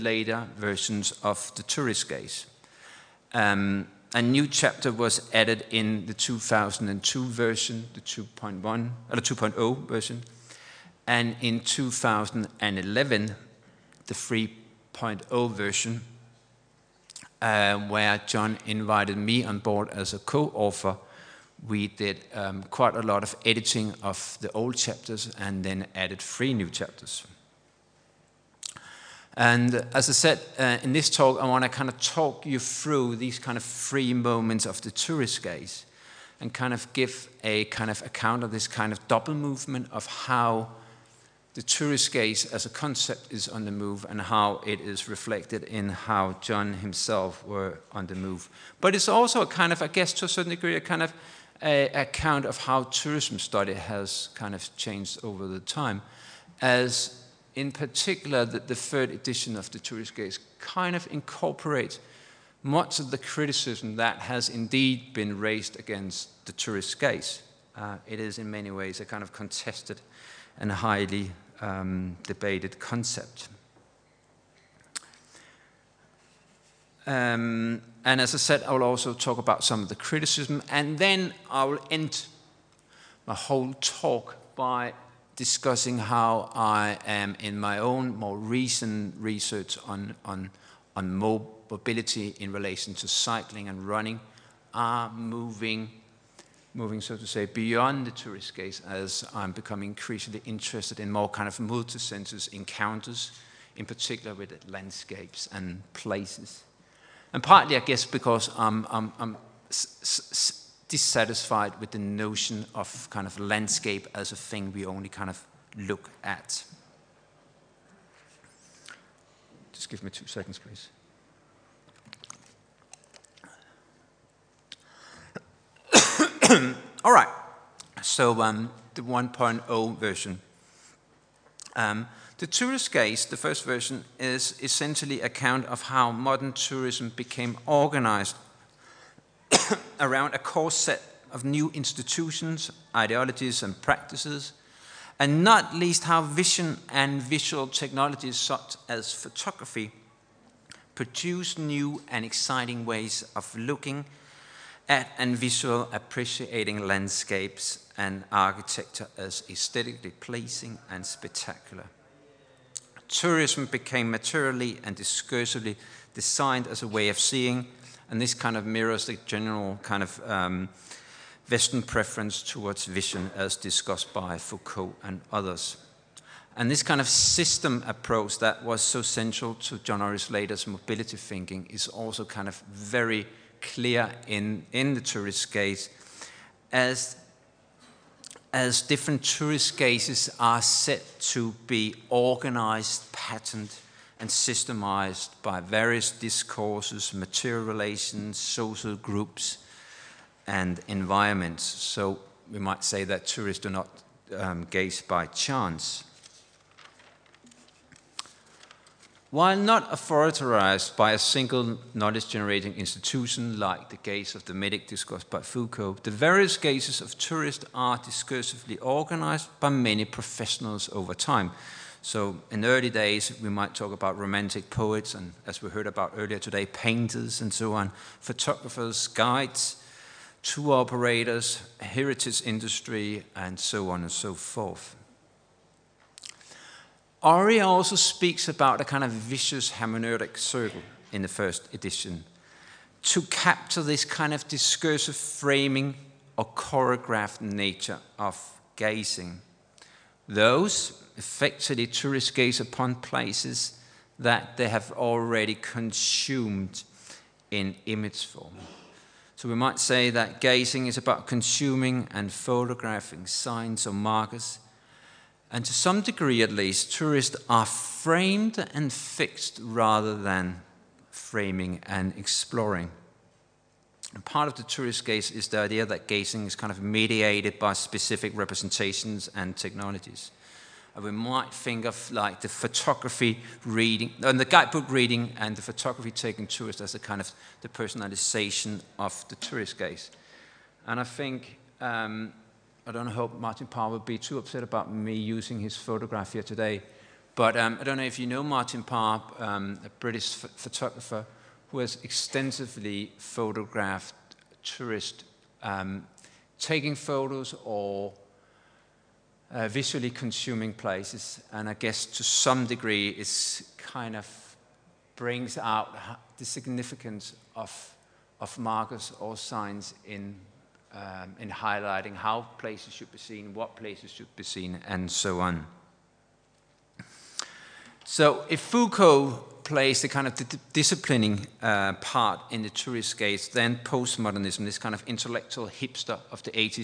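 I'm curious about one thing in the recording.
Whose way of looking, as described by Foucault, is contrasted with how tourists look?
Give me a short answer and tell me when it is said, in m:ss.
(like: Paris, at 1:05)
the medic, at 3:34.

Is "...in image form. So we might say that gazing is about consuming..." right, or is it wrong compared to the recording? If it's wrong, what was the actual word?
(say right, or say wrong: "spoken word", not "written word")
right.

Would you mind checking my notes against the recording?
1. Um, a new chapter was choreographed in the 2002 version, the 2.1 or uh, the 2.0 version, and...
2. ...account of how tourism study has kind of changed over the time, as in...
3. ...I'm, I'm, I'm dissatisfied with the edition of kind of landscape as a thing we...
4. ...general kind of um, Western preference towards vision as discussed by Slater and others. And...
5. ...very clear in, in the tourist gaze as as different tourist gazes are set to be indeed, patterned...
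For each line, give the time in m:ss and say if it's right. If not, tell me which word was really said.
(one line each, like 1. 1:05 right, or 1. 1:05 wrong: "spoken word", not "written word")
1. 0:03 wrong: "added", not "choreographed"
2. 0:51 right
3. 1:48 wrong: "notion", not "edition"
4. 2:49 wrong: "Foucault", not "Slater"
5. 3:02 wrong: "organized", not "indeed".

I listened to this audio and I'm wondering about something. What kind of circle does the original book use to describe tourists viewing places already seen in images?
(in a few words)
vicious hermeneutic circle.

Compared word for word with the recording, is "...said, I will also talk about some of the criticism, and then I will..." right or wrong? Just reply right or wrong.
right.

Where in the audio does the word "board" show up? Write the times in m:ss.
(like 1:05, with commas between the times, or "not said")
0:19.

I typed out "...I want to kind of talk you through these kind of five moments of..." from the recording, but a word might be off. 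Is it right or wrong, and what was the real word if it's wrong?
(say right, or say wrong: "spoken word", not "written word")
wrong: "three", not "five".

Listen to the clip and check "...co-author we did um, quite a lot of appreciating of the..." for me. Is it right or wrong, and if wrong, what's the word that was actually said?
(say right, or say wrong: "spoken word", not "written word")
wrong: "editing", not "appreciating".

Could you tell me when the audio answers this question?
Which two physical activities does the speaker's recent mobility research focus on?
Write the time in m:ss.
1:33.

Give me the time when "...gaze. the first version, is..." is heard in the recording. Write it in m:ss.
2:12.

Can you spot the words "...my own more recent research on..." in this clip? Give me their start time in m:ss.
1:27.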